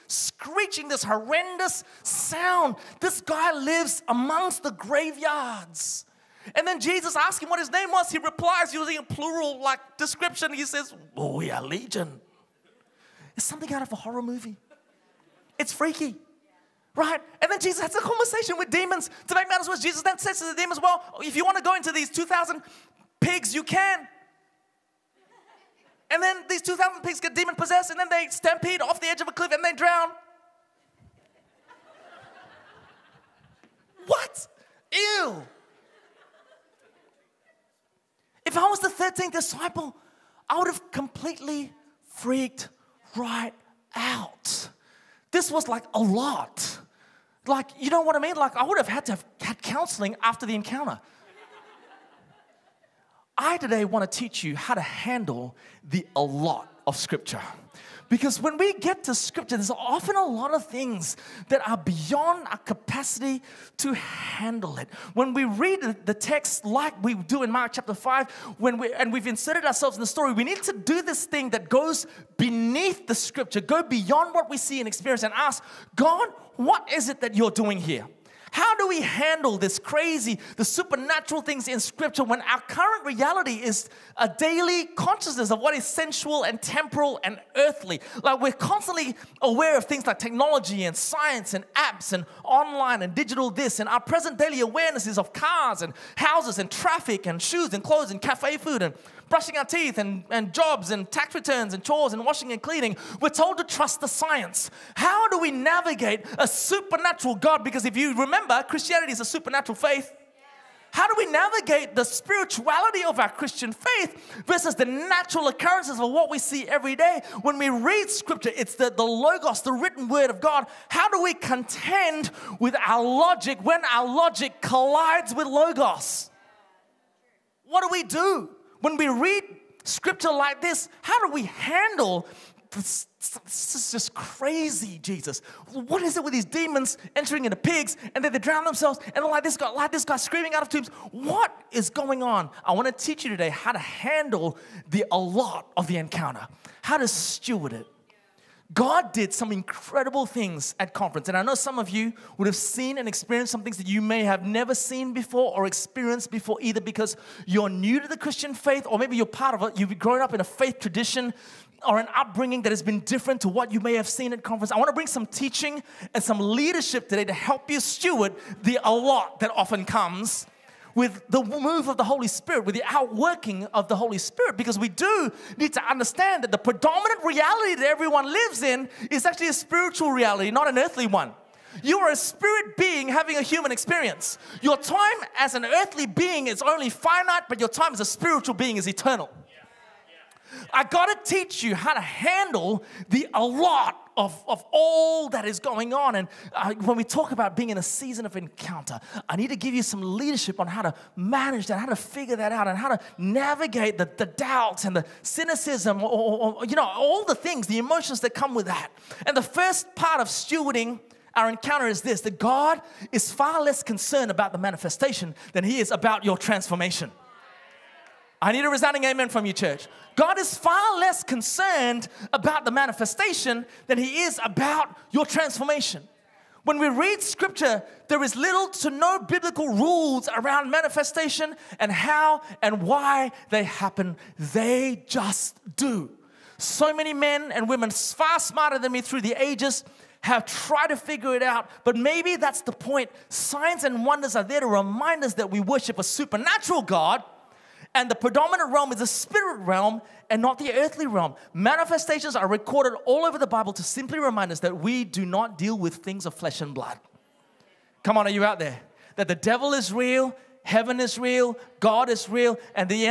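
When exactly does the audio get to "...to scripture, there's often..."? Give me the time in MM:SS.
00:59.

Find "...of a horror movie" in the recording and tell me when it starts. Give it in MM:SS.
00:13.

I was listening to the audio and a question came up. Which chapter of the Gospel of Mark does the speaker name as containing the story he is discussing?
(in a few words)
Chapter 5.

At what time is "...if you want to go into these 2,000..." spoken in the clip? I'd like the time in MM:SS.
00:21.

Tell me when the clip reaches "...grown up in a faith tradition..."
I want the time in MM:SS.
02:39.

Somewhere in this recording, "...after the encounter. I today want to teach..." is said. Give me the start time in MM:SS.
00:50.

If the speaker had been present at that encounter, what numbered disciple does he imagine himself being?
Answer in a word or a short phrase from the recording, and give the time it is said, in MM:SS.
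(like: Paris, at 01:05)
13th, at 00:38.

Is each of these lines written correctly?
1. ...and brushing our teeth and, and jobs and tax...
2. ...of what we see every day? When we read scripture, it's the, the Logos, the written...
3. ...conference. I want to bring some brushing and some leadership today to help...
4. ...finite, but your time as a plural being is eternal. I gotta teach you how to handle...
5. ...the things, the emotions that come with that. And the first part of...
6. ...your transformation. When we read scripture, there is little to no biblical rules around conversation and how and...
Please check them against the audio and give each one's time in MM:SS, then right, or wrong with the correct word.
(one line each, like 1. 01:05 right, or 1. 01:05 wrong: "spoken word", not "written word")
1. 01:38 right
2. 01:55 right
3. 02:44 wrong: "teaching", not "brushing"
4. 03:06 wrong: "spiritual", not "plural"
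5. 03:27 right
6. 03:45 wrong: "manifestation", not "conversation".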